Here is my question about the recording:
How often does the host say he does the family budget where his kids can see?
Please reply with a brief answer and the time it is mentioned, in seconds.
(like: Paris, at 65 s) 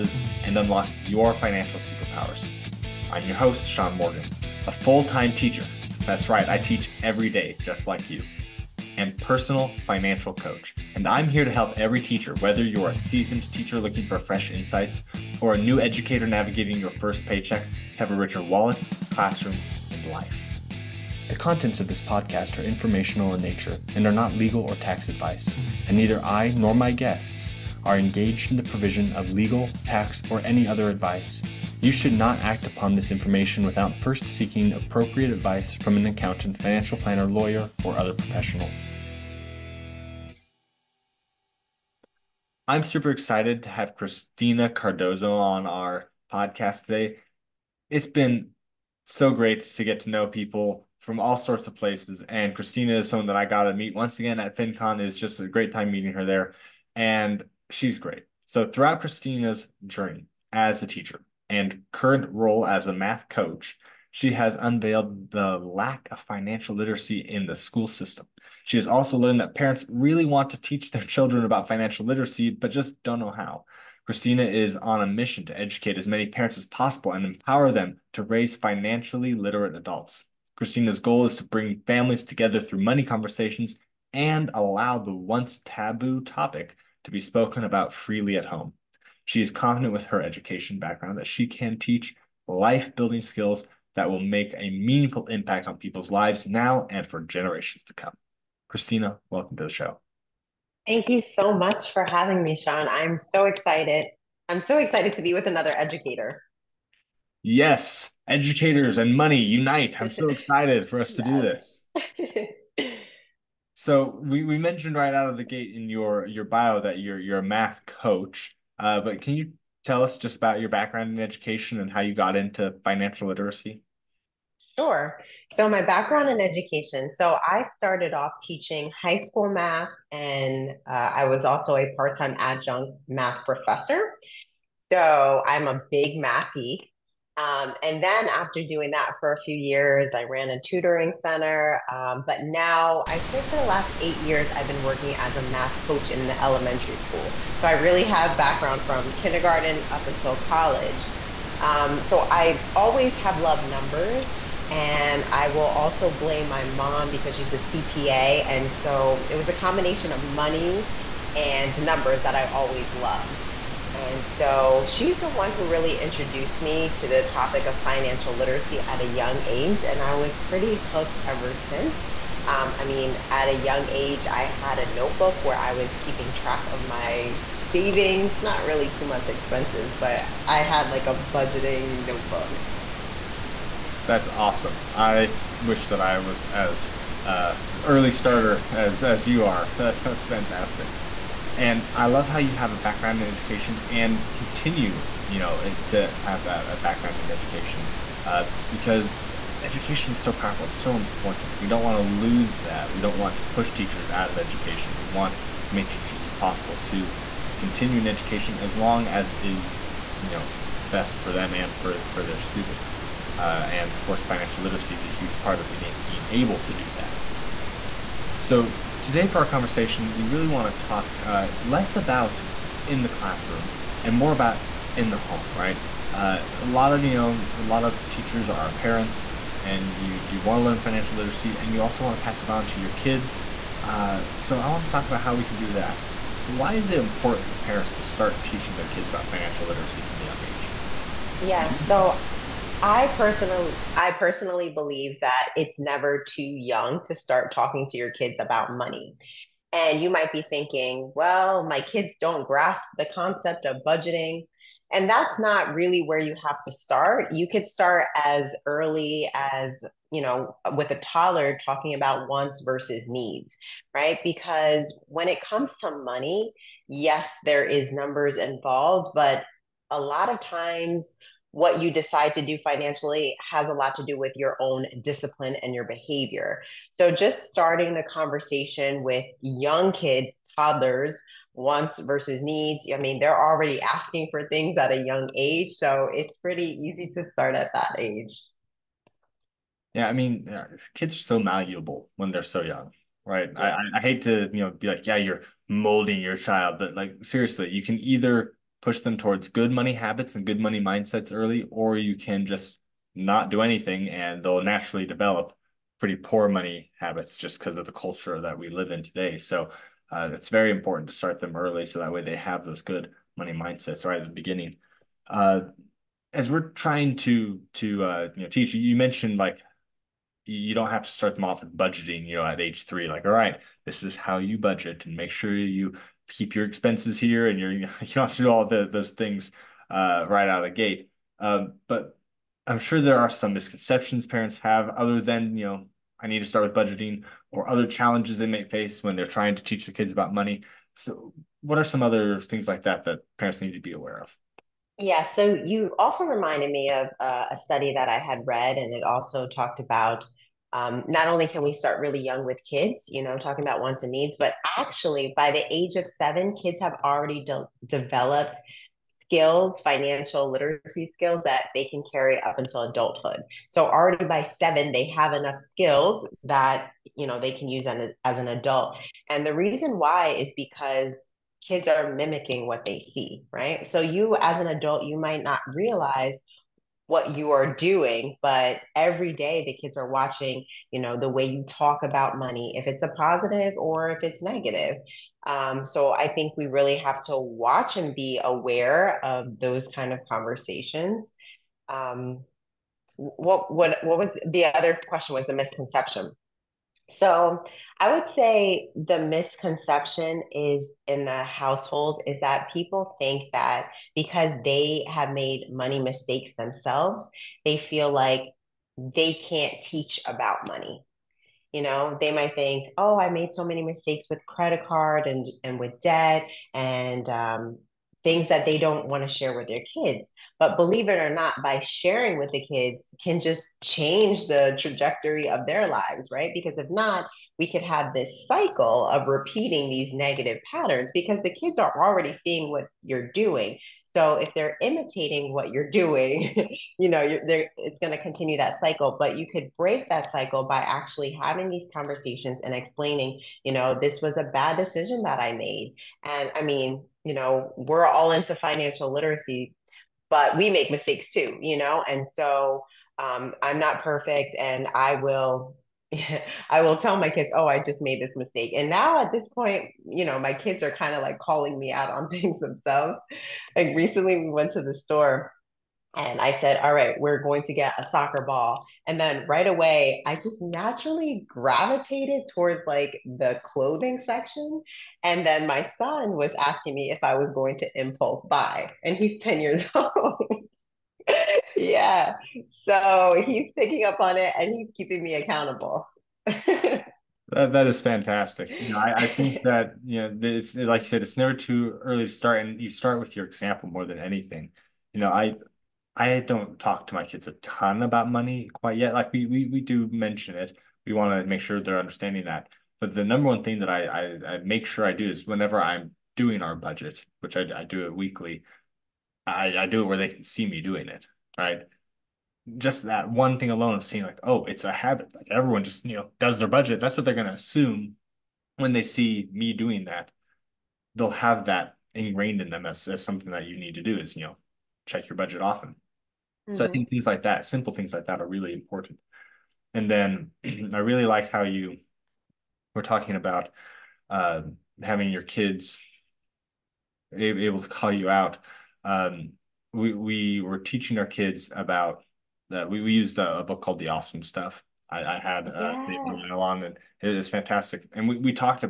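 Weekly, at 508 s.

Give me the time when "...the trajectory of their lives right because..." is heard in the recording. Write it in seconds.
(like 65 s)
424 s.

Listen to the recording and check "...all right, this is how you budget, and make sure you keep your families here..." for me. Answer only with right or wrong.
wrong.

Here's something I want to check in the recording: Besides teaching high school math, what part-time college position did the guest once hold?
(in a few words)
Adjunct math professor.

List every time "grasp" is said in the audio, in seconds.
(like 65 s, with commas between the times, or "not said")
252 s.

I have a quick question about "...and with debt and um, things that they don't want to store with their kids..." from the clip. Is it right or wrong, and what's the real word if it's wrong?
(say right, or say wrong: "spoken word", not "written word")
wrong: "share", not "store".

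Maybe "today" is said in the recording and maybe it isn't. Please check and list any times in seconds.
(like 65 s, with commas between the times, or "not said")
46 s, 219 s, 309 s.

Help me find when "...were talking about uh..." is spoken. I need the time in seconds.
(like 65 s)
532 s.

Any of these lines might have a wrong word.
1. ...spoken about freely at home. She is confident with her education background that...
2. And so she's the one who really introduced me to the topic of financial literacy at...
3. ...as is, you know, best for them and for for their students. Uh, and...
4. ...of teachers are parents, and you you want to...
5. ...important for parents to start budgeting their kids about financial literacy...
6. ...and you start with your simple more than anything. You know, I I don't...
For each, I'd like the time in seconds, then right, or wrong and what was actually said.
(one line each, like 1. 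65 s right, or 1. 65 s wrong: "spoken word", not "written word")
1. 87 s right
2. 163 s right
3. 209 s right
4. 227 s right
5. 236 s wrong: "teaching", not "budgeting"
6. 492 s wrong: "example", not "simple".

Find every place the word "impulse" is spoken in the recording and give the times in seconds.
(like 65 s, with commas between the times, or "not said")
477 s.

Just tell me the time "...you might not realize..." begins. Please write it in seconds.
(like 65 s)
375 s.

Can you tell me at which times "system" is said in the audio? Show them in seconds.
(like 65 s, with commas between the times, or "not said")
67 s.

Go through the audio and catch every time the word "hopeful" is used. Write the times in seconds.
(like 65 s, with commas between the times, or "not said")
not said.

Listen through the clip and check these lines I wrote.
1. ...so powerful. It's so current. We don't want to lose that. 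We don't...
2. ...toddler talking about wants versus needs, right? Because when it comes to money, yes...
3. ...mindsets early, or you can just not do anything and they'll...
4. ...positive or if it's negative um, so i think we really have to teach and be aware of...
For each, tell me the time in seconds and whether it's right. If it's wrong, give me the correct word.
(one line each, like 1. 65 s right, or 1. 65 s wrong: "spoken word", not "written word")
1. 200 s wrong: "important", not "current"
2. 260 s right
3. 300 s right
4. 383 s wrong: "watch", not "teach".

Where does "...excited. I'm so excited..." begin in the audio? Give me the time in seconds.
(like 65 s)
103 s.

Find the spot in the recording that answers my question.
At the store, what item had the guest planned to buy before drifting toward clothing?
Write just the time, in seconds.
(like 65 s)
468 s.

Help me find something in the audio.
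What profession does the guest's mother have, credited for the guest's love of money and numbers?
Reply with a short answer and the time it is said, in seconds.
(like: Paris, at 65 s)
CPA, at 157 s.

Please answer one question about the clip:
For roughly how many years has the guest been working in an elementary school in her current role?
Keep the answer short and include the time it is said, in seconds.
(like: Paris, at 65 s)
8, at 144 s.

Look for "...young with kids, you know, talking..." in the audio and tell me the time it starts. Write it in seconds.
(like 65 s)
352 s.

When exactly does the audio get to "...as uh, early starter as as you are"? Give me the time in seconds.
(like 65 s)
186 s.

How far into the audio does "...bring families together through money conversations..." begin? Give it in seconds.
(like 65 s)
81 s.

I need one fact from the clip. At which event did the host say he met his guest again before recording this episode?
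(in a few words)
FinCon.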